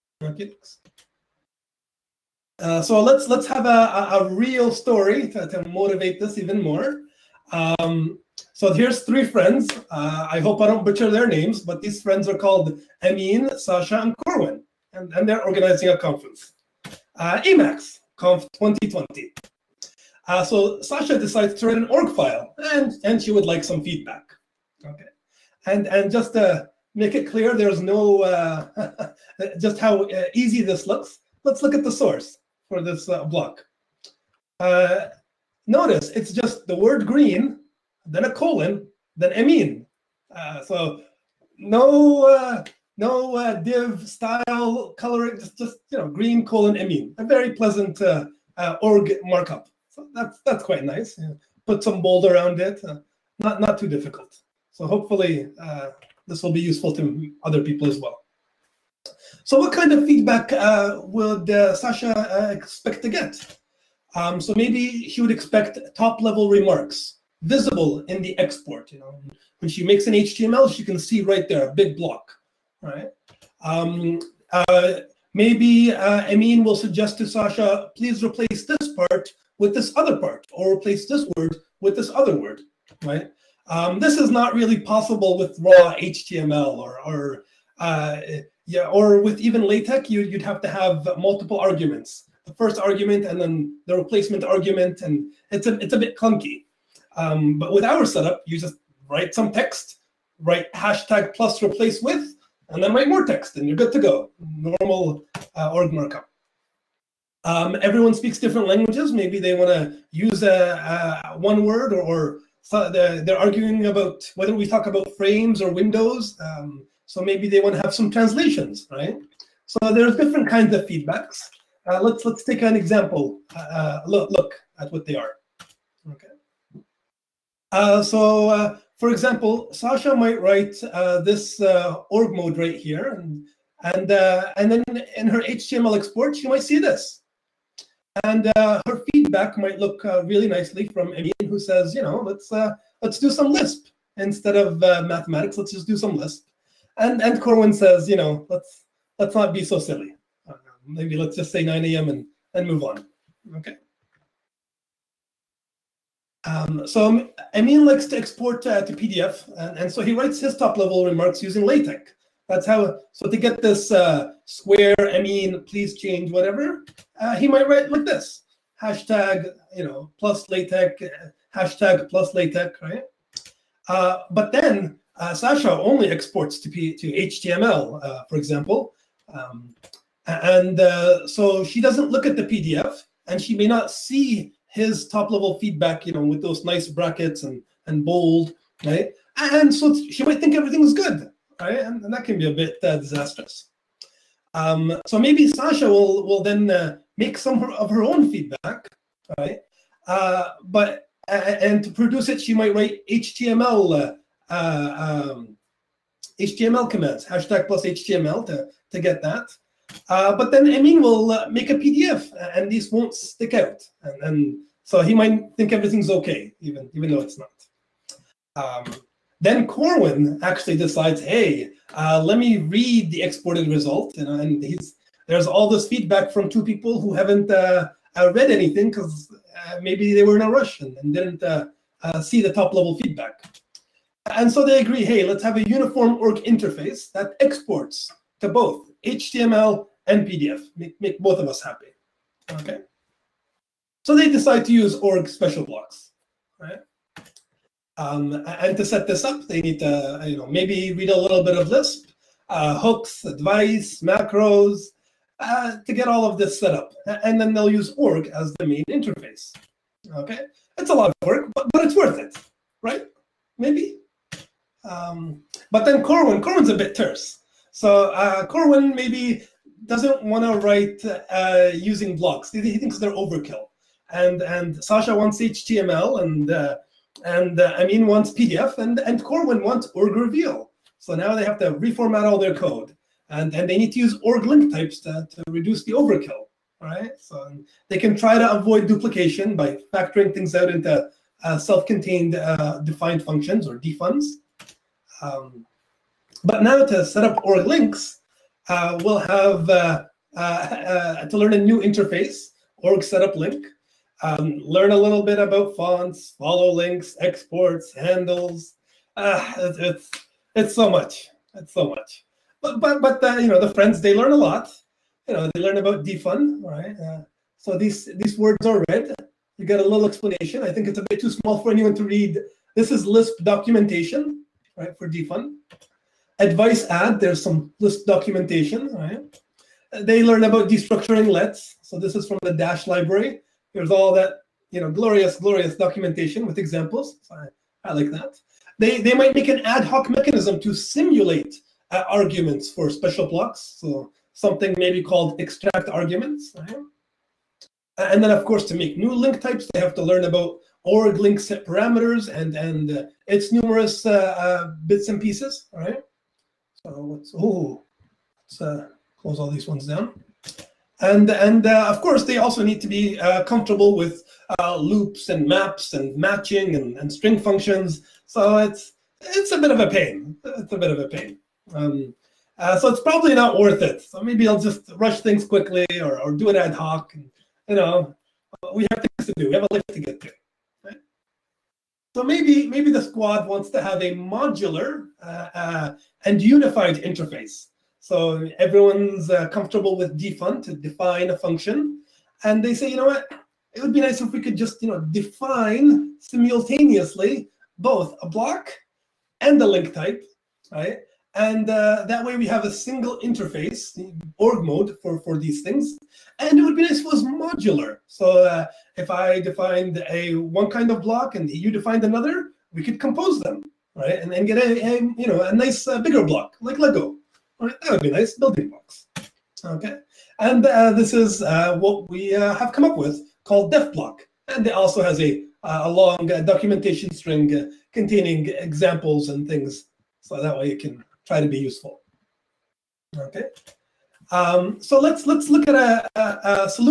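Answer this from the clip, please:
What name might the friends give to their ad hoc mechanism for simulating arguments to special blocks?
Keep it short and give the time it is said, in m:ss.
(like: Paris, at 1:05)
extract arguments, at 5:45.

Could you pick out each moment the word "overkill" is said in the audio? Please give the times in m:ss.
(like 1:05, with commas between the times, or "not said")
4:33, 4:45.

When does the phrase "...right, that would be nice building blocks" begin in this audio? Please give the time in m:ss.
6:57.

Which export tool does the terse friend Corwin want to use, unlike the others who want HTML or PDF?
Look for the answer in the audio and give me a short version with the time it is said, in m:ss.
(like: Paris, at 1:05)
org reveal, at 4:39.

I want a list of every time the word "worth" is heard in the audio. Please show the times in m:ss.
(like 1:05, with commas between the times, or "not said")
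4:21, 6:13.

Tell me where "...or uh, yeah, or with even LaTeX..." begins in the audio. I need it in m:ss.
1:27.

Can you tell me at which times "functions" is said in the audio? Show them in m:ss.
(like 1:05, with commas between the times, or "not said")
4:53, 6:07, 6:31.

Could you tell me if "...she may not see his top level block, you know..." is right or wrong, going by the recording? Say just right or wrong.
wrong.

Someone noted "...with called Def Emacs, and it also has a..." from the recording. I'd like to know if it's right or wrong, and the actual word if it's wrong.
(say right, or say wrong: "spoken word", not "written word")
wrong: "Block", not "Emacs".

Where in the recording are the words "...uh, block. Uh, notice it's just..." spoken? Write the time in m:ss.
0:33.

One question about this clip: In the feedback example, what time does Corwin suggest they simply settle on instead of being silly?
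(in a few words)
9 a.m.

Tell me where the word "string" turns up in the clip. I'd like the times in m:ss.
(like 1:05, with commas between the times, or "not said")
6:07, 7:07.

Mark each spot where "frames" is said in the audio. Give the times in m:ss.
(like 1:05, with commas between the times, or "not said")
1:55.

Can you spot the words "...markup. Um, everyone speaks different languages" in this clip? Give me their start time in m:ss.
1:45.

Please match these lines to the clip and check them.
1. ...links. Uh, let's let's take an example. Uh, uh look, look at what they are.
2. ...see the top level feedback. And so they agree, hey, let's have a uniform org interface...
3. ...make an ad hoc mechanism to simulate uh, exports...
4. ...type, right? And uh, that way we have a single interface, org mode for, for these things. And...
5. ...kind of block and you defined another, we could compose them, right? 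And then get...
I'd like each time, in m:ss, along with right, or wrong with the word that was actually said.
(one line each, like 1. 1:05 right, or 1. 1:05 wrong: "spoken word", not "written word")
1. 2:00 wrong: "feedbacks", not "links"
2. 3:52 right
3. 5:39 wrong: "arguments", not "exports"
4. 6:39 right
5. 6:50 right.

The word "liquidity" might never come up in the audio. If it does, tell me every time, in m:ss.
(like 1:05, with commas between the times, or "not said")
not said.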